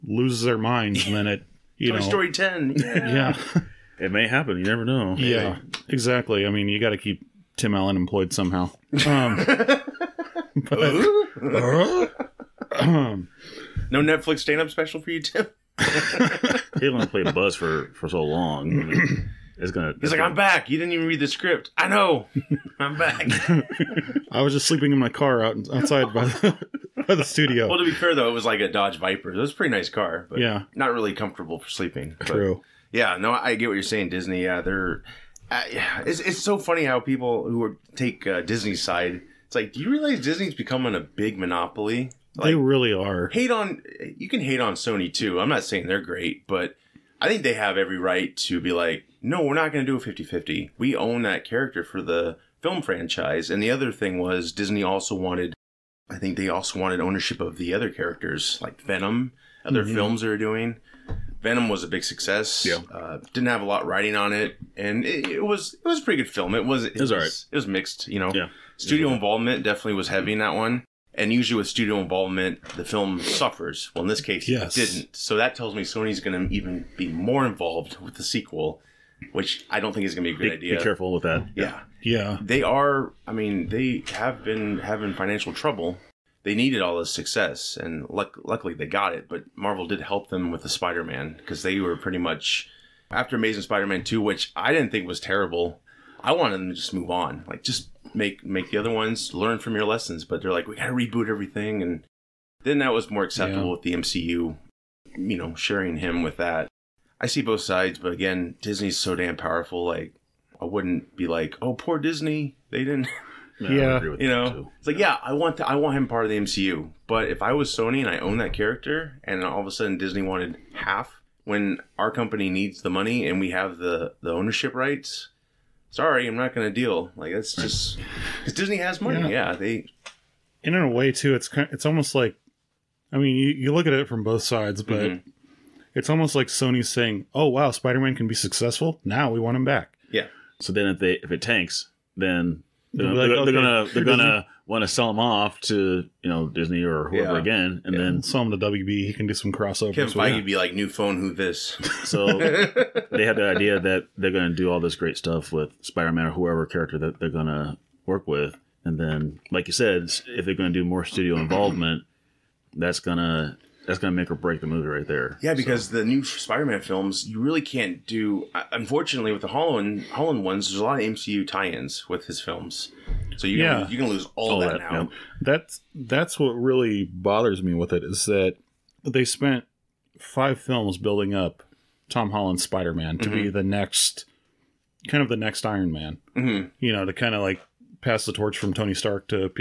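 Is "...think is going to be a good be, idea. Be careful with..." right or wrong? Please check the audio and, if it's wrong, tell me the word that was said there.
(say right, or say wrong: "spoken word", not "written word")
right.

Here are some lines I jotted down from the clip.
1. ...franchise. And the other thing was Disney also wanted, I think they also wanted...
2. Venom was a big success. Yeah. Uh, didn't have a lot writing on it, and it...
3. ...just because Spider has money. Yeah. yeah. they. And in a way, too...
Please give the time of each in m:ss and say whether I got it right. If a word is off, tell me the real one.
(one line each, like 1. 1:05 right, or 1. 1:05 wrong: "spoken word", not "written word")
1. 0:52 right
2. 1:01 right
3. 2:07 wrong: "Disney", not "Spider".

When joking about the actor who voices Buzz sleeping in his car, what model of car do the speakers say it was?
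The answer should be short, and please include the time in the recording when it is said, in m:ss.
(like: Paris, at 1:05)
Dodge Viper, at 0:28.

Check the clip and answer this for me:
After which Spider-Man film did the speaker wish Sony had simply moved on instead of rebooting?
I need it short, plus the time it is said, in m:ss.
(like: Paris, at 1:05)
Amazing Spider-Man 2, at 1:33.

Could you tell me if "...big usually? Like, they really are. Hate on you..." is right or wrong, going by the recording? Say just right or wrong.
wrong.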